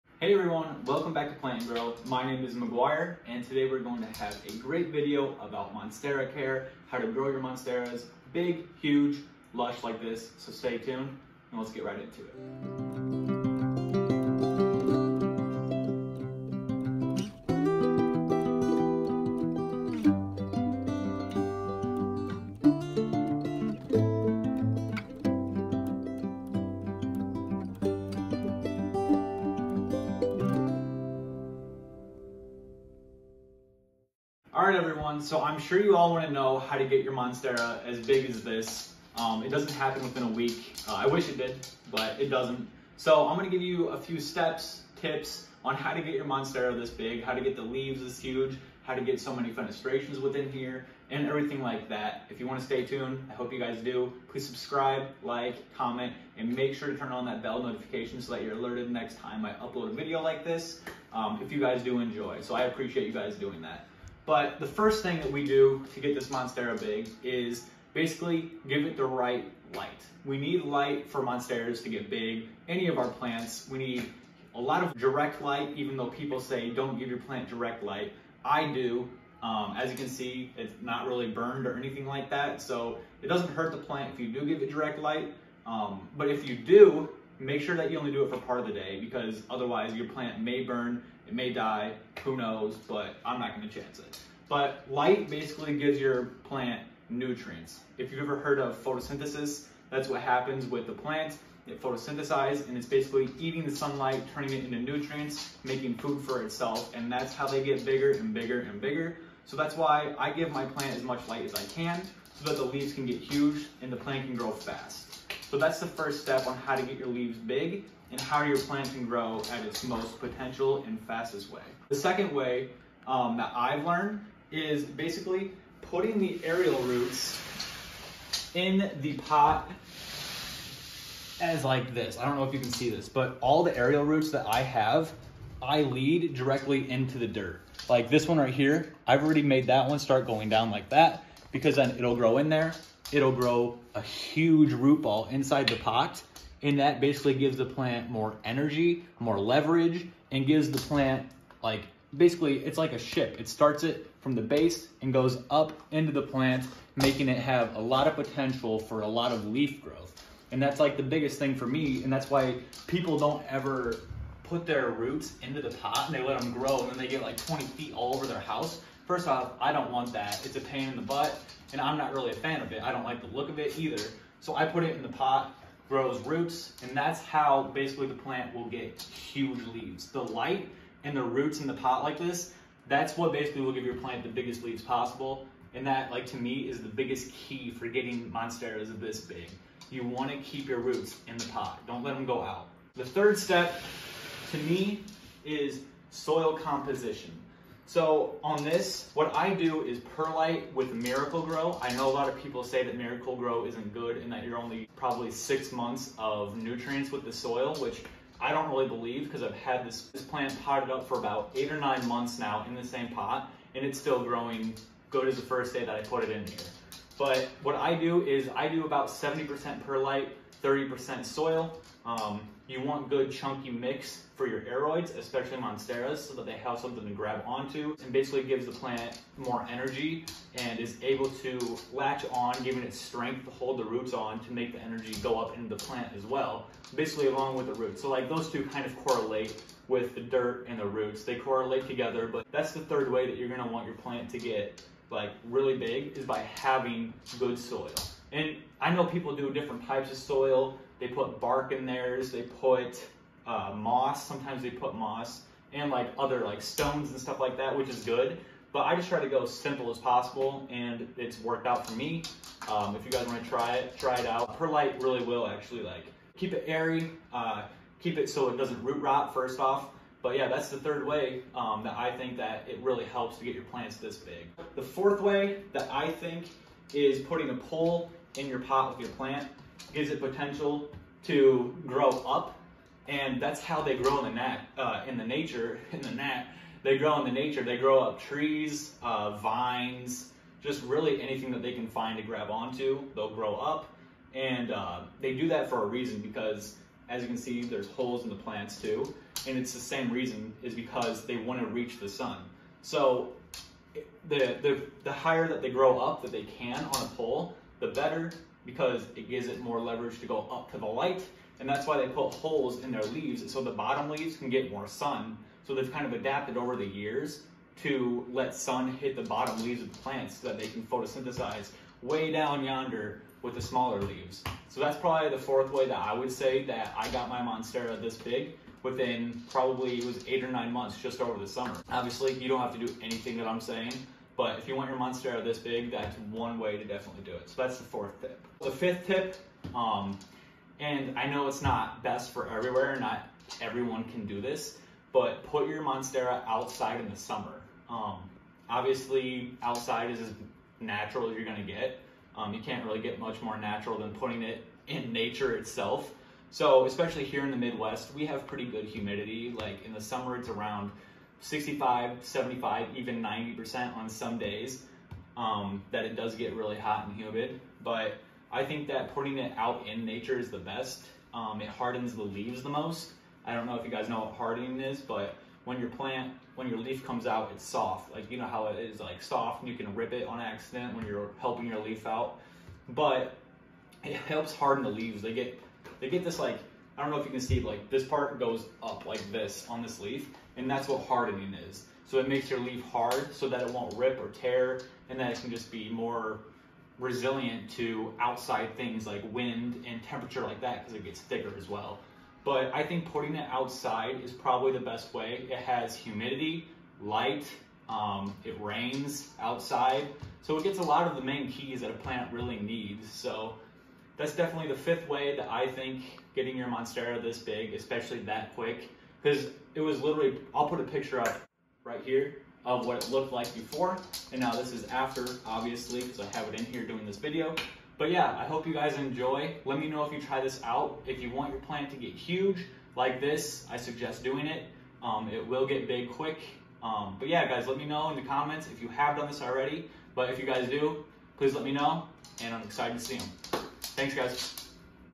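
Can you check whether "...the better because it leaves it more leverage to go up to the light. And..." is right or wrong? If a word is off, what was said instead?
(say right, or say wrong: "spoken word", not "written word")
wrong: "gives", not "leaves".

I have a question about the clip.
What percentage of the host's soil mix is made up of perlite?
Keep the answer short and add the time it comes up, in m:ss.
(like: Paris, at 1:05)
70%, at 3:39.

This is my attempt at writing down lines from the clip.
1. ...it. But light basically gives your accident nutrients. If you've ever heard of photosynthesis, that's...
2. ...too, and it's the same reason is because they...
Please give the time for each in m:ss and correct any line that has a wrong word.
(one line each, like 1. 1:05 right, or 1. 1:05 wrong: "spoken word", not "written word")
1. 1:33 wrong: "plant", not "accident"
2. 4:58 right.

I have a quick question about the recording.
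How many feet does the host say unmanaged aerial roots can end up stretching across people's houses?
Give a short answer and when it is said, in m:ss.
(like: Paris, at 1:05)
20 feet, at 2:47.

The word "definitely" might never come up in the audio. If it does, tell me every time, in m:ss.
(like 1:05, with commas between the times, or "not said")
5:36, 6:54.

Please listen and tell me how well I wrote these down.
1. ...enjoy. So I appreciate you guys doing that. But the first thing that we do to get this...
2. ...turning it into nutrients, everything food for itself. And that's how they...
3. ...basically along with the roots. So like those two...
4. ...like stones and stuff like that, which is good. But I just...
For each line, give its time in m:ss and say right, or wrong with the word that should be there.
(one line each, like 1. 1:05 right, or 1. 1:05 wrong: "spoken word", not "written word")
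1. 1:01 right
2. 1:44 wrong: "making", not "everything"
3. 3:56 right
4. 4:16 right.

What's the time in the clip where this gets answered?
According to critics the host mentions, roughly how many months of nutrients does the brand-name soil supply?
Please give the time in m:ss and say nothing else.
3:25.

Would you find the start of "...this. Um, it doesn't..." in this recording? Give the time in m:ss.
0:38.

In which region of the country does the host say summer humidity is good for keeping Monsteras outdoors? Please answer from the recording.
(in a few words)
Midwest.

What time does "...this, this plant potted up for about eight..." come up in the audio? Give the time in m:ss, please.
3:29.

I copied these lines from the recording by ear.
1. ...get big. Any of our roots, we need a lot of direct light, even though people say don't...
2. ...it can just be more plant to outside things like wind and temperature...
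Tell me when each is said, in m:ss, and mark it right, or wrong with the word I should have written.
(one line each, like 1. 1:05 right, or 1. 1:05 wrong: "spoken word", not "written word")
1. 1:11 wrong: "plants", not "roots"
2. 6:35 wrong: "resilient", not "plant".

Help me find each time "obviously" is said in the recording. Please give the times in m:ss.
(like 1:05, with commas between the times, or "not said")
5:31, 5:48, 7:05.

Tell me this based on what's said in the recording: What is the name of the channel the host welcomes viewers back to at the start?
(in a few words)
Plant Grow.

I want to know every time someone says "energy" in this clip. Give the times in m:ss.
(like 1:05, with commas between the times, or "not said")
2:28, 3:49, 3:54.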